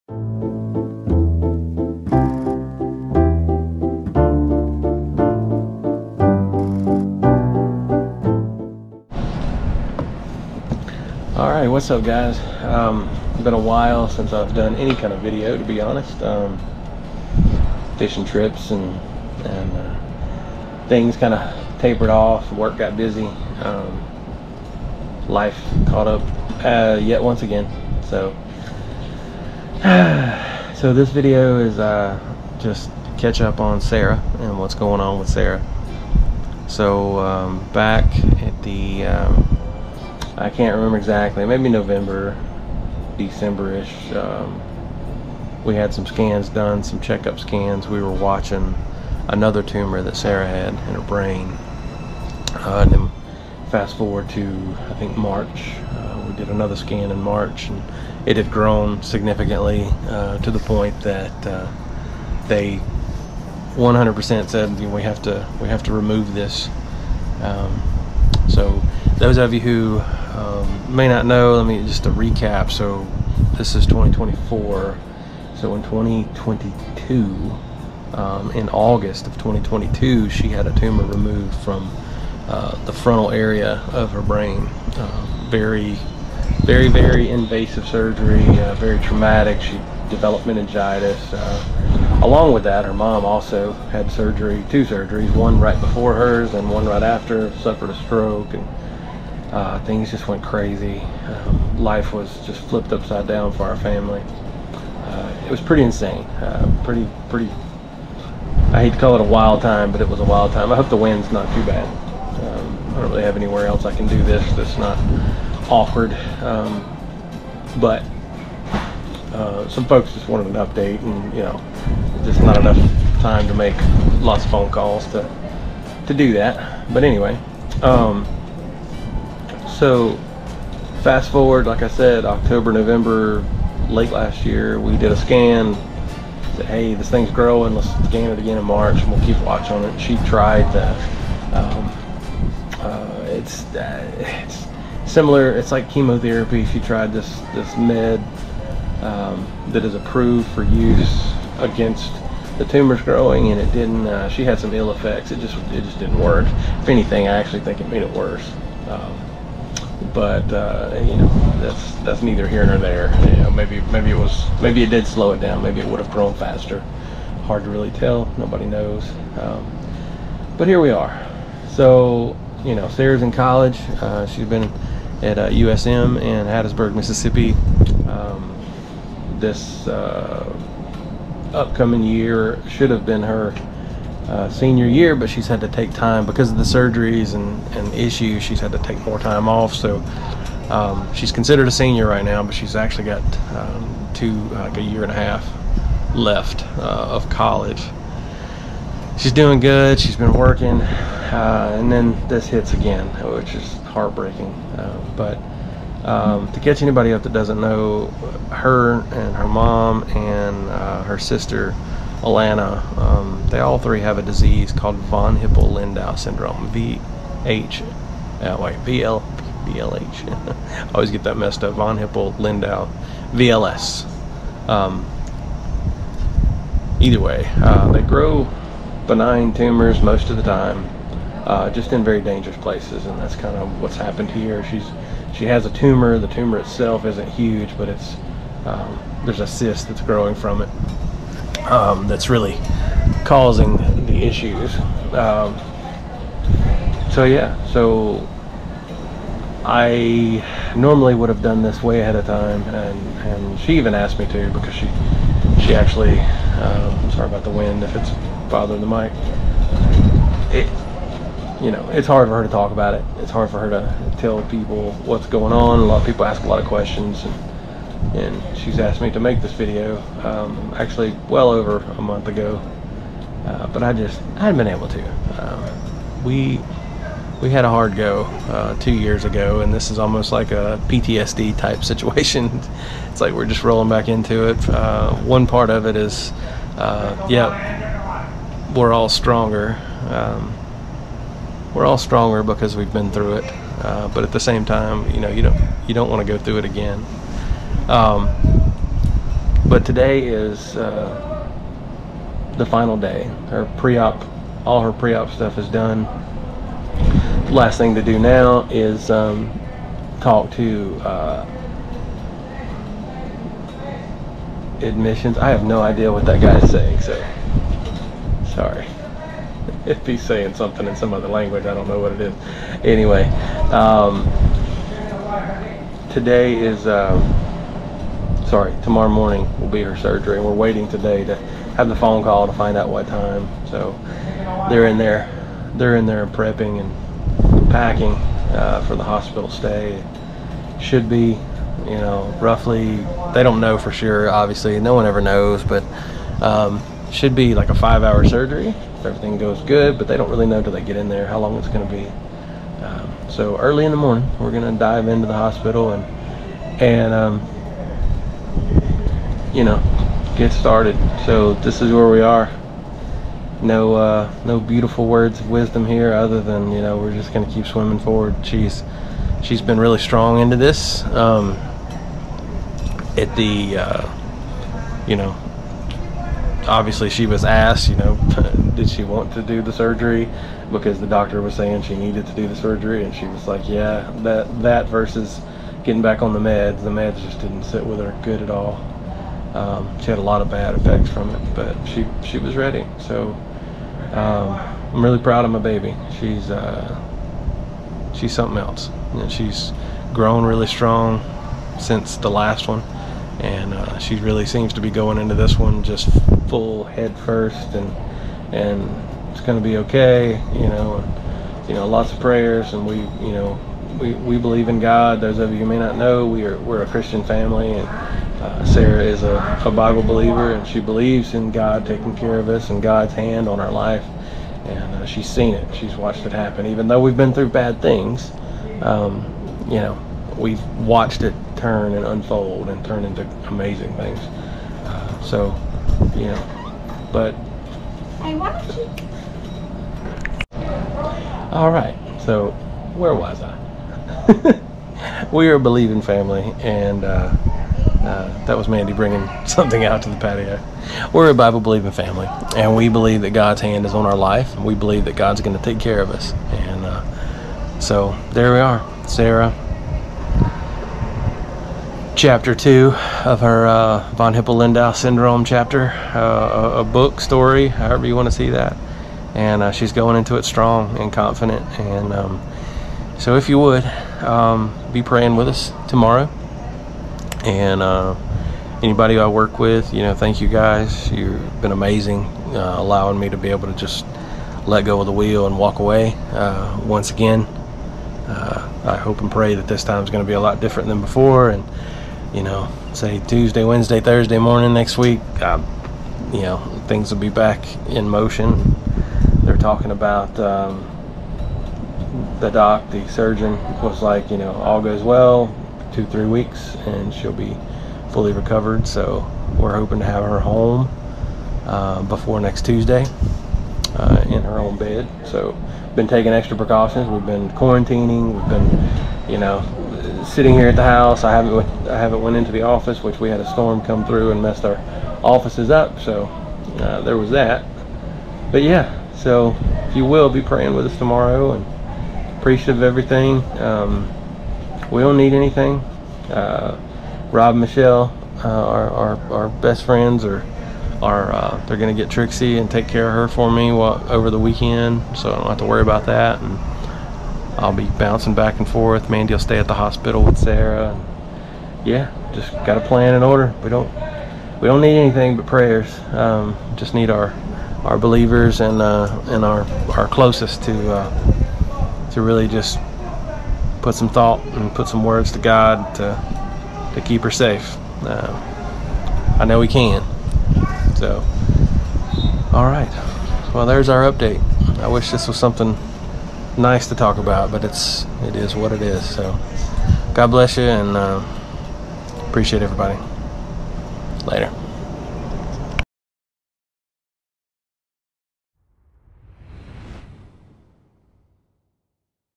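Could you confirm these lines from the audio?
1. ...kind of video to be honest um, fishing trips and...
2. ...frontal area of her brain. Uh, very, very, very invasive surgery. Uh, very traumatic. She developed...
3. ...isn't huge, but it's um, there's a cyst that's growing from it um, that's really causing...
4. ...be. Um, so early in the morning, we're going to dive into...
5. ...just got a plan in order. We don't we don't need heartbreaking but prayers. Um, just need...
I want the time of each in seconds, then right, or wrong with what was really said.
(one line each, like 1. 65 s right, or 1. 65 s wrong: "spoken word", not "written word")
1. 14 s right
2. 82 s right
3. 237 s right
4. 351 s right
5. 552 s wrong: "anything", not "heartbreaking".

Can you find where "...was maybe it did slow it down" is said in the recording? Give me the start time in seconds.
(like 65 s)
164 s.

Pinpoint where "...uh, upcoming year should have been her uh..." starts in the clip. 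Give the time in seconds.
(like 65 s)
179 s.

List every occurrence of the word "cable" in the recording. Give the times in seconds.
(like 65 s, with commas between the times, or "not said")
not said.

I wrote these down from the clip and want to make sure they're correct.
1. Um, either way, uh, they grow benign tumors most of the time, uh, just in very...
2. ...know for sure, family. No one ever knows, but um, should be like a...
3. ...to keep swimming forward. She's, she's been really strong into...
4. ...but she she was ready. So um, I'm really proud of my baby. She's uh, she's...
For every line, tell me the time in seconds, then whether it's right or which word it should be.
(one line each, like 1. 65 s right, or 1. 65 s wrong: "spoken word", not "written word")
1. 224 s right
2. 343 s wrong: "obviously", not "family"
3. 367 s right
4. 391 s right.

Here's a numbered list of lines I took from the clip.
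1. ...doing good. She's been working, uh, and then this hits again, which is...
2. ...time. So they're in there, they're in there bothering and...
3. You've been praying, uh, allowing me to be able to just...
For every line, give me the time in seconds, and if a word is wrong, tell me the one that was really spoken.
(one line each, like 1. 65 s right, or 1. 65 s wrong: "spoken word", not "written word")
1. 199 s right
2. 333 s wrong: "prepping", not "bothering"
3. 481 s wrong: "amazing", not "praying".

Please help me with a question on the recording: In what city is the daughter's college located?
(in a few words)
Hattiesburg.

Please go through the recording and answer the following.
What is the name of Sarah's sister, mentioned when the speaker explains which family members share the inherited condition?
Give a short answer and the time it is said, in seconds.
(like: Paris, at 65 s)
Alana, at 212 s.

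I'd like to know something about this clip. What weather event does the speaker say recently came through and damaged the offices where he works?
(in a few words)
A storm.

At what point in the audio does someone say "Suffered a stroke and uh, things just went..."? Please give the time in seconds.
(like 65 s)
97 s.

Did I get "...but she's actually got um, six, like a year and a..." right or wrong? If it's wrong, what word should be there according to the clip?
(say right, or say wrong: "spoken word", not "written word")
wrong: "two", not "six".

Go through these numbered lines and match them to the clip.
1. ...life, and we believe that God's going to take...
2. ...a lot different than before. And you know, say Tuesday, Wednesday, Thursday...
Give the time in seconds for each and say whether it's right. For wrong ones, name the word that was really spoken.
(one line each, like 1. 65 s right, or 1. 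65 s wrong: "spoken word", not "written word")
1. 454 s right
2. 490 s right.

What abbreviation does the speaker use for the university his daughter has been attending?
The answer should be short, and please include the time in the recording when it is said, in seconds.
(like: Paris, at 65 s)
USM, at 175 s.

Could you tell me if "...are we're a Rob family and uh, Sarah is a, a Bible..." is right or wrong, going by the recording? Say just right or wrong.
wrong.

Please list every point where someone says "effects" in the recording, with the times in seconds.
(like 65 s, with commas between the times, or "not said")
154 s, 390 s.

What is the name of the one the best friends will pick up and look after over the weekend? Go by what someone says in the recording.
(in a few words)
Trixie.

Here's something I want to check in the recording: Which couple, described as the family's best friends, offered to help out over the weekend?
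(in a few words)
Rob and Michelle.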